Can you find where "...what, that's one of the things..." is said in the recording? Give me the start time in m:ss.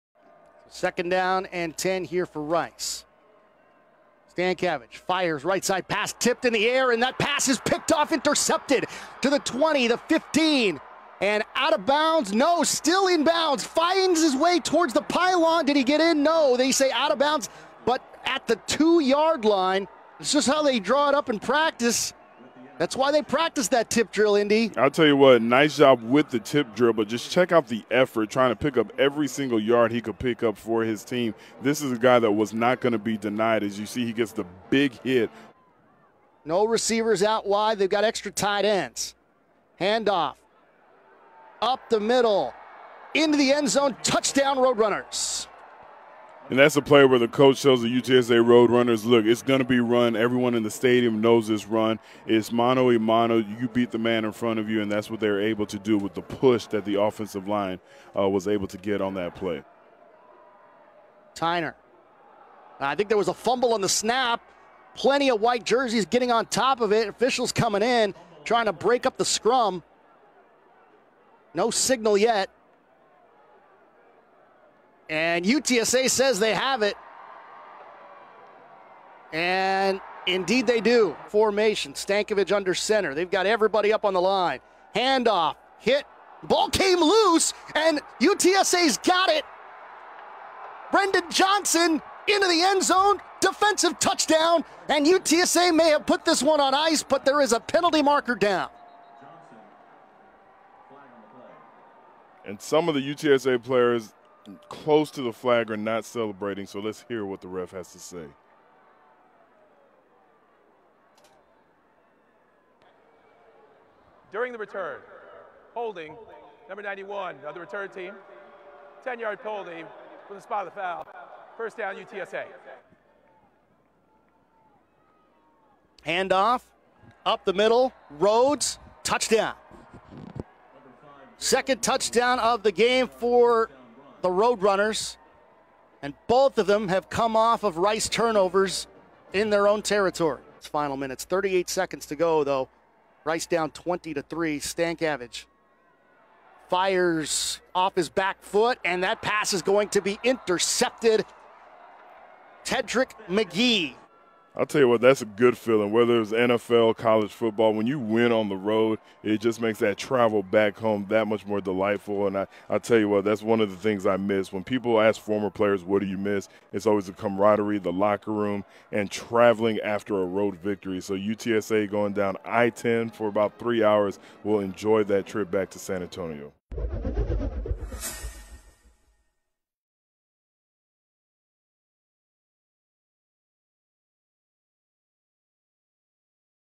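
2:43.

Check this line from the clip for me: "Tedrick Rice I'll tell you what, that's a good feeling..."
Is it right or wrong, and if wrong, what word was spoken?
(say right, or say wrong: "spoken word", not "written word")
wrong: "McGee", not "Rice".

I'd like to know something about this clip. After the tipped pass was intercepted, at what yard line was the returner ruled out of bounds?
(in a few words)
2 yard line.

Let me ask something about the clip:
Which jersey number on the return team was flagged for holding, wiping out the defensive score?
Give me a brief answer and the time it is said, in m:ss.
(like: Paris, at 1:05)
91, at 1:56.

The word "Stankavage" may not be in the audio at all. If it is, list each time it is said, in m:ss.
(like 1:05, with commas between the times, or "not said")
0:04, 1:21, 2:24.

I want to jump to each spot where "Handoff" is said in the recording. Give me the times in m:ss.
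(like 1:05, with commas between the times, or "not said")
0:39, 1:24, 2:06.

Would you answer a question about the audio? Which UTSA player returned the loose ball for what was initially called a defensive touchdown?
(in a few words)
Brendan Johnson.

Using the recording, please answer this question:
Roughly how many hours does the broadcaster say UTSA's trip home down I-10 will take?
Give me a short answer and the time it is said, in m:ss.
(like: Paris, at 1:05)
3 hours, at 2:53.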